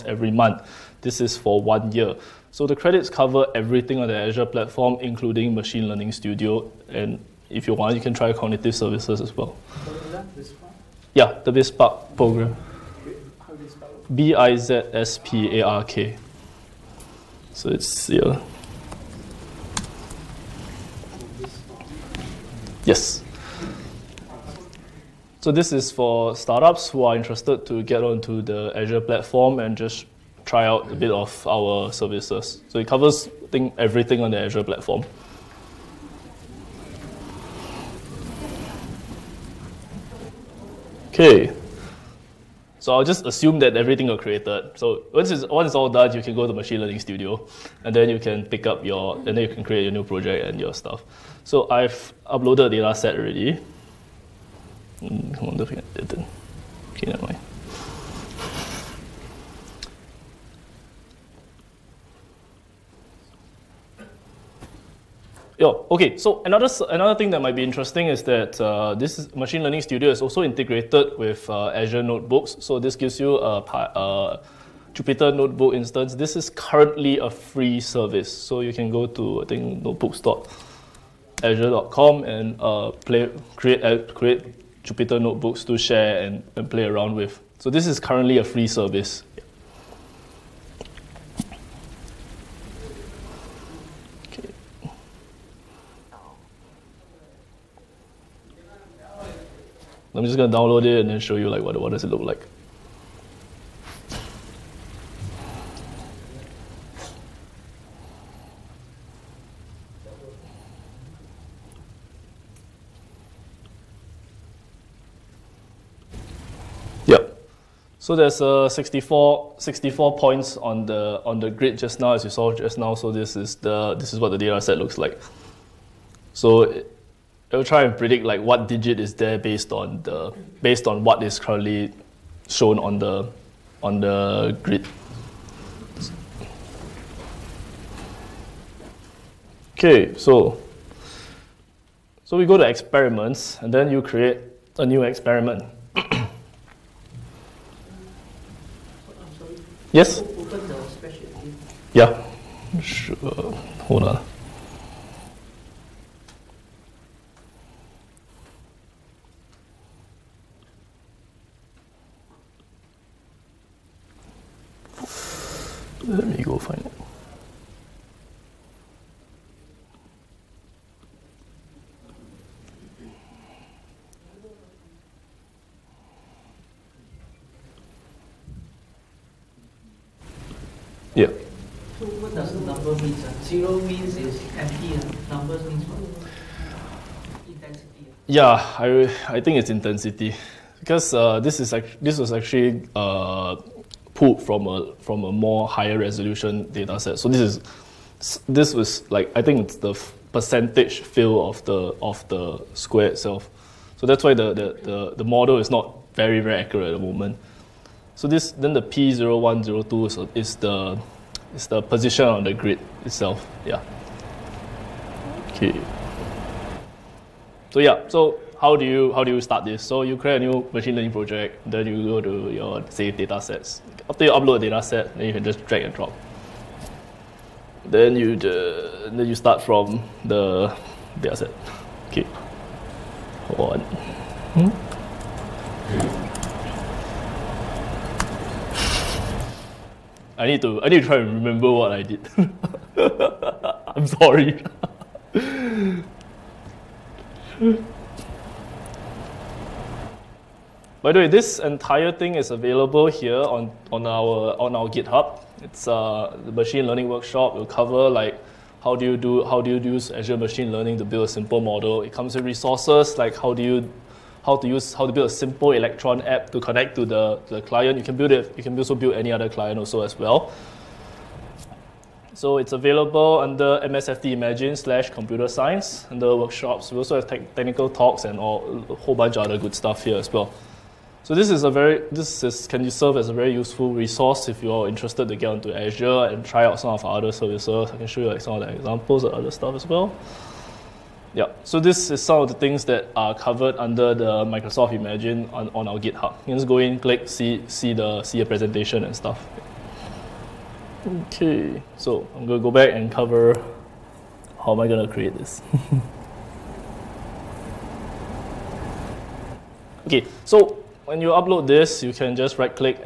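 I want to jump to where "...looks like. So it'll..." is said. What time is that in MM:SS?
02:04.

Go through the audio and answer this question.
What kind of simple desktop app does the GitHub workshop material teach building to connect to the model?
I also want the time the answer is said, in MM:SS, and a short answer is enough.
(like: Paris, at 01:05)
Electron app, at 04:25.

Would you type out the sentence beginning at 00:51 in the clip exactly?
So I've uploaded the data set already.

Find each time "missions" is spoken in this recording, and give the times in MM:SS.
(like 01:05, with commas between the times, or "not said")
not said.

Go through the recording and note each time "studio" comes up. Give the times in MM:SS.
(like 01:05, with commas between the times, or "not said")
00:06, 00:47, 01:09.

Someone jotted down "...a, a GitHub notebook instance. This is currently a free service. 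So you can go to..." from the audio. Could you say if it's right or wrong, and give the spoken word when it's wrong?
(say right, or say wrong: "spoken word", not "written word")
wrong: "Jupyter", not "GitHub".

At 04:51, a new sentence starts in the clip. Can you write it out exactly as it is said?
Yeah, so this is some of the things that are covered under the Microsoft Imagine on, on our GitHub.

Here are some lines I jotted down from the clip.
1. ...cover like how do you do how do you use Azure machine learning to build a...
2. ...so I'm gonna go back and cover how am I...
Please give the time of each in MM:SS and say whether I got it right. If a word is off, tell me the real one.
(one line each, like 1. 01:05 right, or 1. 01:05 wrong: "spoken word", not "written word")
1. 04:17 right
2. 05:01 right.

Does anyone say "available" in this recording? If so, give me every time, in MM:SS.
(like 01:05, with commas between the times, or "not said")
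04:12, 04:32.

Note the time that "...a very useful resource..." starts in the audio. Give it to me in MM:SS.
04:43.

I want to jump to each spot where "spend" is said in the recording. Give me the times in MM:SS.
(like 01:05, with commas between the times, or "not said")
not said.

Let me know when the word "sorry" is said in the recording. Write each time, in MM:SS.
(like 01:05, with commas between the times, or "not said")
04:04.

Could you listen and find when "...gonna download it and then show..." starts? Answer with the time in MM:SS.
01:40.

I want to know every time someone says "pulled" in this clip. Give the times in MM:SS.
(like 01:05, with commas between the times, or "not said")
03:14.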